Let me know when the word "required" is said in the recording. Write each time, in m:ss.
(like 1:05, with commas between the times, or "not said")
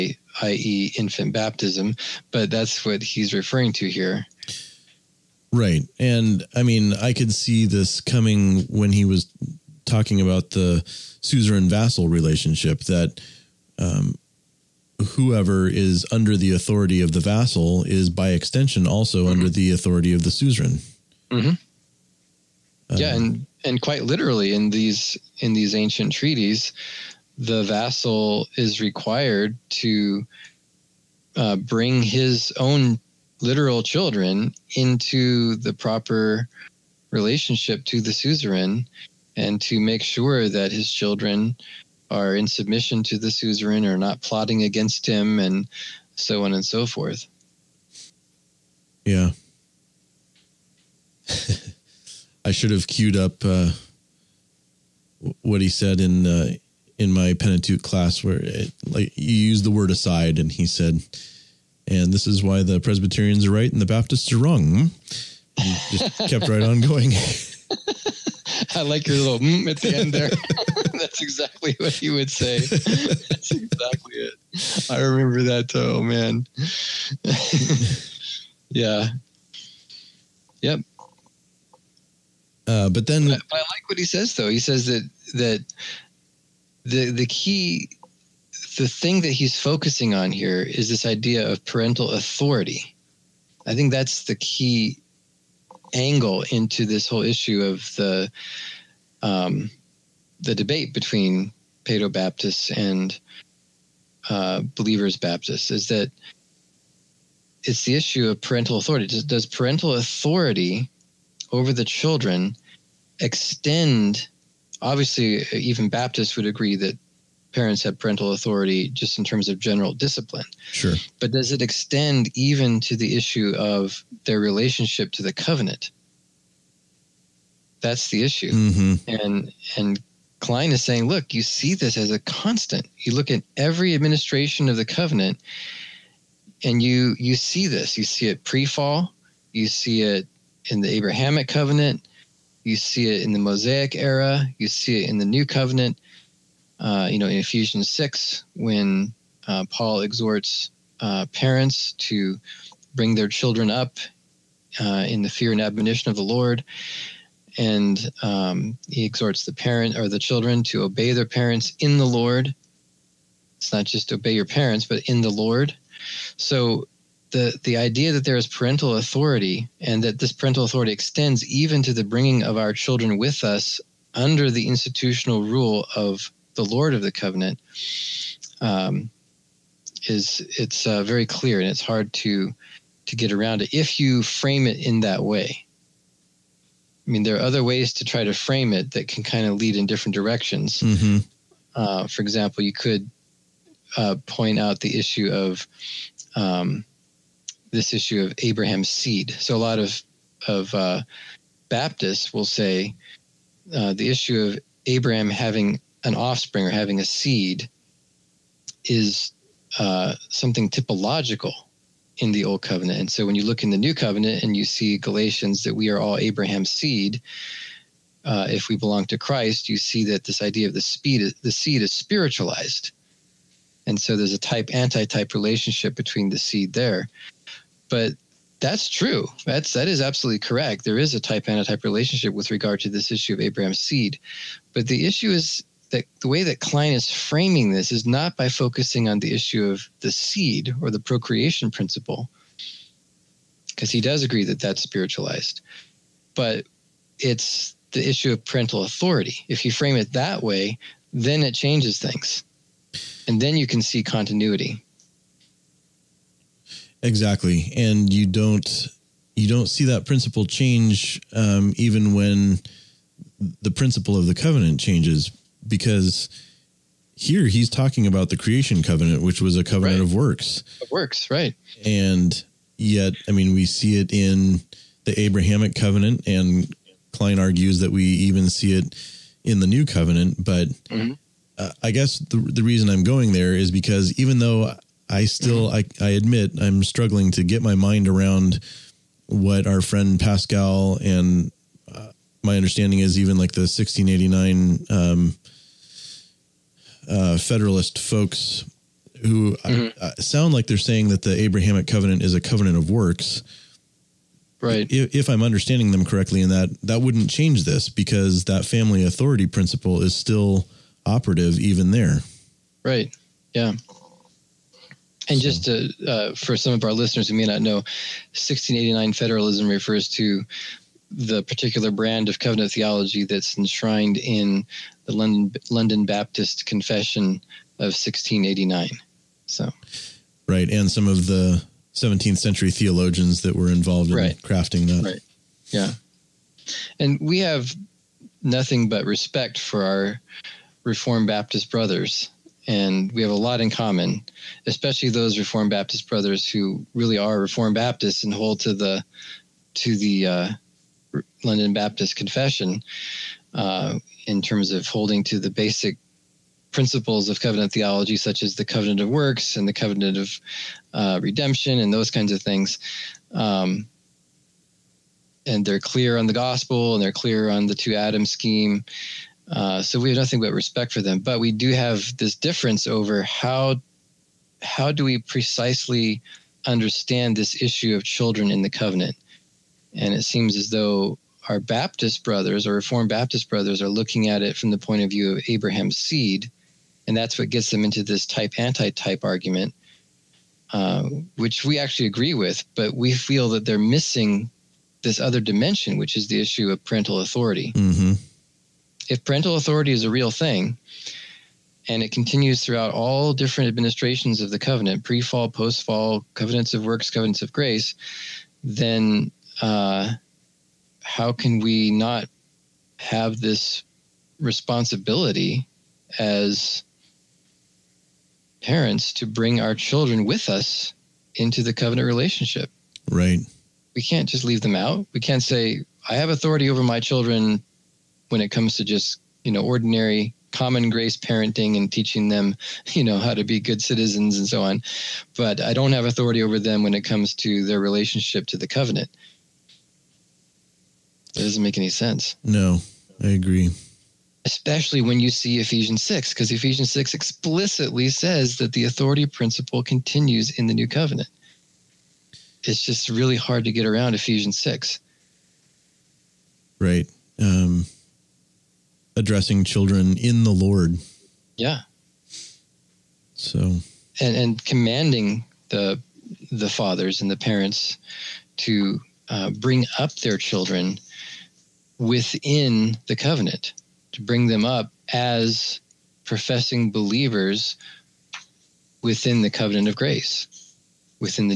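0:28.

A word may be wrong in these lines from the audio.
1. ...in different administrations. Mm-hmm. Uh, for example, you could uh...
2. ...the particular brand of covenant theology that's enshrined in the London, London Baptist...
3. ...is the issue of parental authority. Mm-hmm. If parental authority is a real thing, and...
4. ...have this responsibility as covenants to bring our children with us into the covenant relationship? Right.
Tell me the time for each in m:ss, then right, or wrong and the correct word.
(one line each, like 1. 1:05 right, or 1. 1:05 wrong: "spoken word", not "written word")
1. 3:09 wrong: "directions", not "administrations"
2. 5:21 right
3. 6:36 right
4. 6:52 wrong: "parents", not "covenants".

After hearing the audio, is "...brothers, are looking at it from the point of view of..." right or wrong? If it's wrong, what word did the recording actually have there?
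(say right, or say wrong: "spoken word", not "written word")
right.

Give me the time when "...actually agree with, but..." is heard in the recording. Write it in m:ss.
6:31.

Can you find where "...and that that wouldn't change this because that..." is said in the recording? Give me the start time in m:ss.
5:06.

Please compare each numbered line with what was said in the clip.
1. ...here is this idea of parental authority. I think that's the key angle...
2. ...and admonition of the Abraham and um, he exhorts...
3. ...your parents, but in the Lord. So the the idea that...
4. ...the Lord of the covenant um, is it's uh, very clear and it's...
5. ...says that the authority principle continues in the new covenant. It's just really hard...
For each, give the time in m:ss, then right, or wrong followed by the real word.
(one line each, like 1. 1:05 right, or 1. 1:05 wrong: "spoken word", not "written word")
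1. 1:30 right
2. 2:35 wrong: "Lord", not "Abraham"
3. 2:44 right
4. 2:56 right
5. 7:28 right.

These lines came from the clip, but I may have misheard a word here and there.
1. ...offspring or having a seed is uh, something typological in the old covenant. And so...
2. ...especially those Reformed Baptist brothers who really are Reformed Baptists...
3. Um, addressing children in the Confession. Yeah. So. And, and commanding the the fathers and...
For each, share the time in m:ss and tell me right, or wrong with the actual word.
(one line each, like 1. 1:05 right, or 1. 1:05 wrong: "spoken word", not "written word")
1. 3:26 right
2. 5:44 right
3. 7:37 wrong: "Lord", not "Confession".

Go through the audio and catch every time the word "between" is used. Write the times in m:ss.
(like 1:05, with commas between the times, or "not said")
1:40, 3:45.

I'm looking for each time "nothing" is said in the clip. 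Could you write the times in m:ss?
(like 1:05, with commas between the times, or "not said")
5:38, 6:10.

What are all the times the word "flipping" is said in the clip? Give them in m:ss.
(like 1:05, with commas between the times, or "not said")
not said.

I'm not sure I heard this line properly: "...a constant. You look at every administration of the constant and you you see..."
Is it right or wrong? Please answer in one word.
wrong.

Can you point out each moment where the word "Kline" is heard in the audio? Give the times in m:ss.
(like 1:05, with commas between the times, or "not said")
2:10, 3:56, 4:37.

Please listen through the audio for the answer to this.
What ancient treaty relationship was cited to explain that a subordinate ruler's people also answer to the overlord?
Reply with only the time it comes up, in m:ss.
0:10.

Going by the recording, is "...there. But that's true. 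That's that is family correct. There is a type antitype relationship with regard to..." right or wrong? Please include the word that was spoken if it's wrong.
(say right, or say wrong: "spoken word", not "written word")
wrong: "absolutely", not "family".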